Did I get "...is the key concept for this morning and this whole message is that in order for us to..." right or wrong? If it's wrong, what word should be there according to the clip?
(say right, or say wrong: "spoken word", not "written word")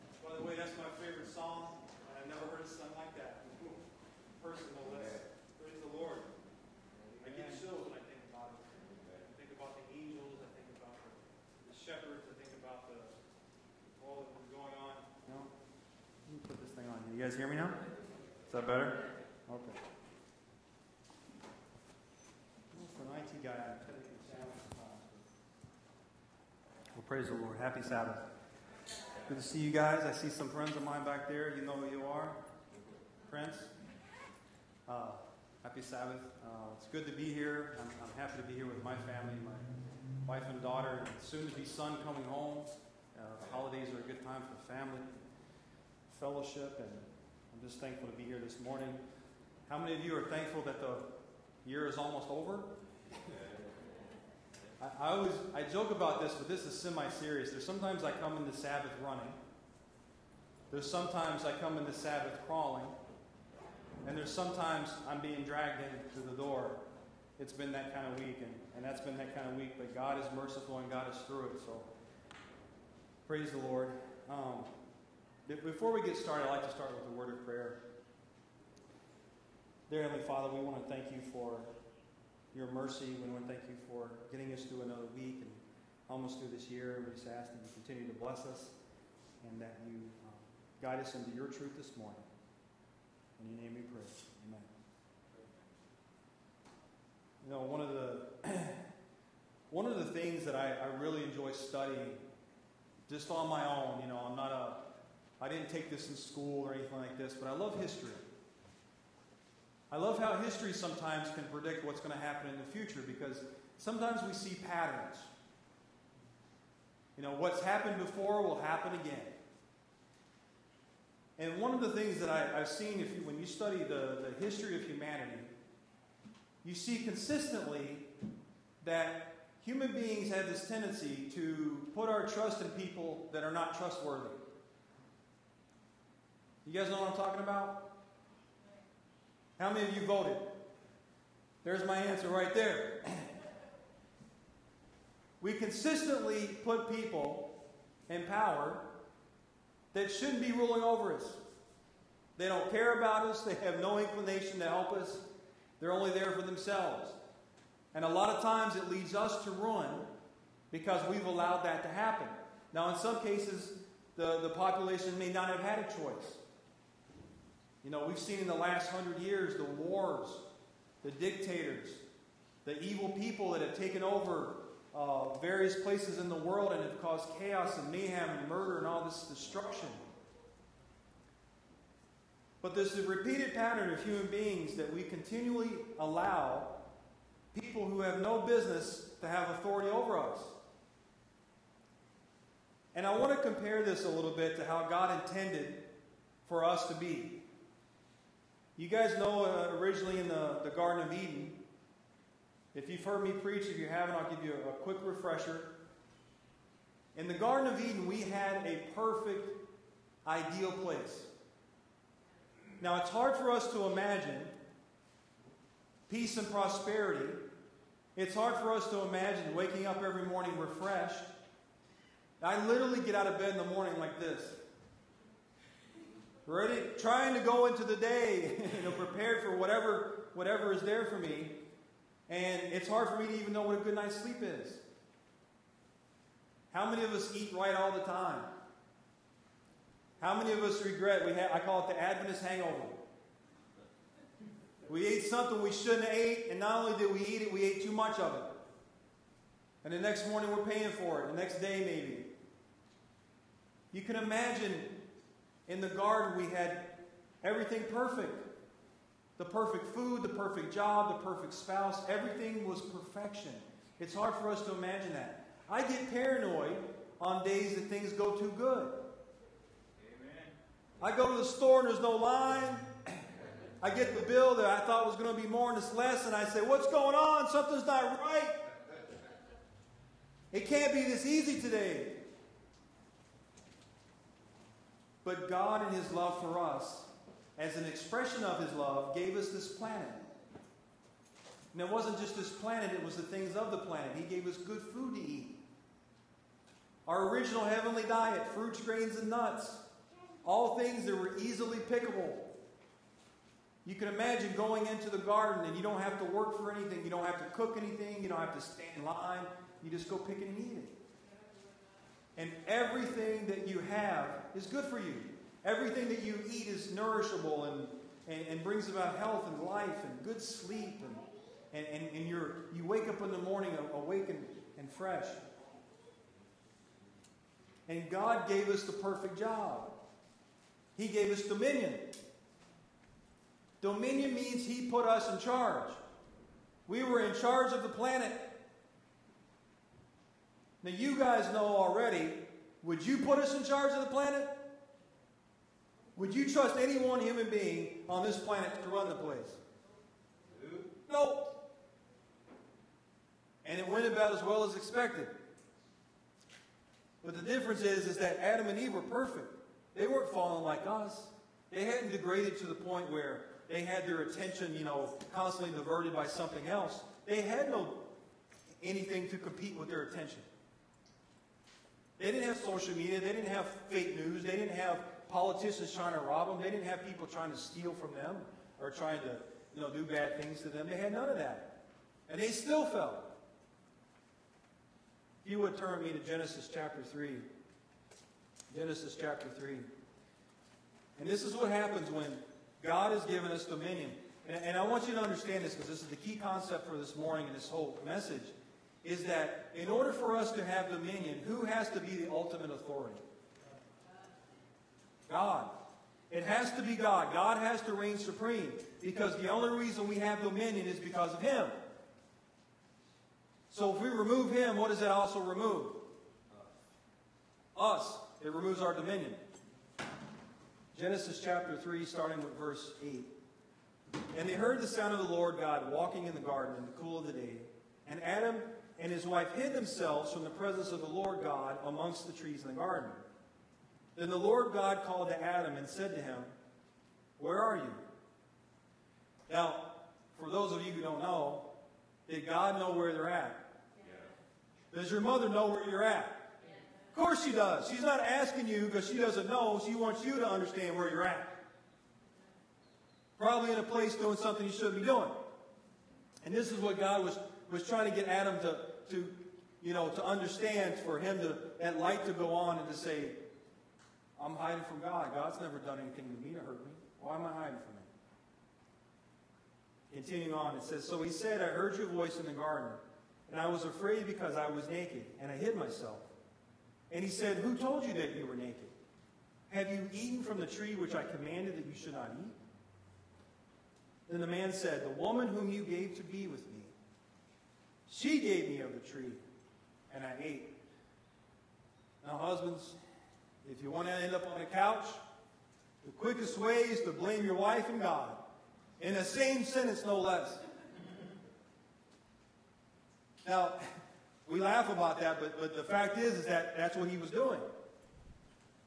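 right.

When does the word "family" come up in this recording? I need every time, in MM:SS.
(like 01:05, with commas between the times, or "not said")
00:39, 00:44.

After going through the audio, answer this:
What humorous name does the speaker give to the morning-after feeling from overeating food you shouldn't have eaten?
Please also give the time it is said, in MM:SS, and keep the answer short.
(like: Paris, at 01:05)
Adventist hangover, at 04:02.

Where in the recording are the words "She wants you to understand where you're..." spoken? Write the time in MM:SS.
07:29.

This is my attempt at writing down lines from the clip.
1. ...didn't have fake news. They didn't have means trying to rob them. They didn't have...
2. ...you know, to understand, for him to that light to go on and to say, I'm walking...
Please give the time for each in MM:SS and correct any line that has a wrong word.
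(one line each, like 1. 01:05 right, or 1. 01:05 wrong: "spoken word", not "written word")
1. 06:13 wrong: "politicians", not "means"
2. 07:39 wrong: "hiding", not "walking".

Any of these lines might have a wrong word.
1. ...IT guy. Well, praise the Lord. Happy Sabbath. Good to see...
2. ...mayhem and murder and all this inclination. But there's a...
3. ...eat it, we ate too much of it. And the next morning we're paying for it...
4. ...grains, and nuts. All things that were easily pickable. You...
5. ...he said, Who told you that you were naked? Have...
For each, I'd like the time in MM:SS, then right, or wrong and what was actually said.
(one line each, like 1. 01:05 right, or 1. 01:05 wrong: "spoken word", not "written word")
1. 00:23 right
2. 02:57 wrong: "destruction", not "inclination"
3. 04:07 right
4. 04:58 right
5. 07:57 right.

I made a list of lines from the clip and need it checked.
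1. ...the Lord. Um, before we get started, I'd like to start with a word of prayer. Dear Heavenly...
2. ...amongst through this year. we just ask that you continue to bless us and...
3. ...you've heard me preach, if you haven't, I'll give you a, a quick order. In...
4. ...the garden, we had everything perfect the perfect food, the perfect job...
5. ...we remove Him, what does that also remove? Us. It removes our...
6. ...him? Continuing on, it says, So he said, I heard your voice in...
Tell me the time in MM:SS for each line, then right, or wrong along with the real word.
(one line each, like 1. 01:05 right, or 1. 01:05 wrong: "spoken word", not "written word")
1. 01:13 right
2. 01:26 wrong: "almost", not "amongst"
3. 03:22 wrong: "refresher", not "order"
4. 04:15 right
5. 06:54 right
6. 07:50 right.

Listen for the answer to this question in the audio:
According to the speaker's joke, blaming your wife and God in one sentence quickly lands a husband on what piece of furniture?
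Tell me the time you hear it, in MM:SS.
08:14.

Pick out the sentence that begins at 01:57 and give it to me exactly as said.
You know, what's happened before will happen again.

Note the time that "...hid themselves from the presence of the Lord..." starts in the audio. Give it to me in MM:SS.
07:09.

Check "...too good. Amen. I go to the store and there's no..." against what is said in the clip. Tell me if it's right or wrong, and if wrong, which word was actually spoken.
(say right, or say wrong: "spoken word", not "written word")
right.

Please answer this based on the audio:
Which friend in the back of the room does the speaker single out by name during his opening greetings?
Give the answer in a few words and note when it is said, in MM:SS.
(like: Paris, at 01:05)
Prince, at 00:33.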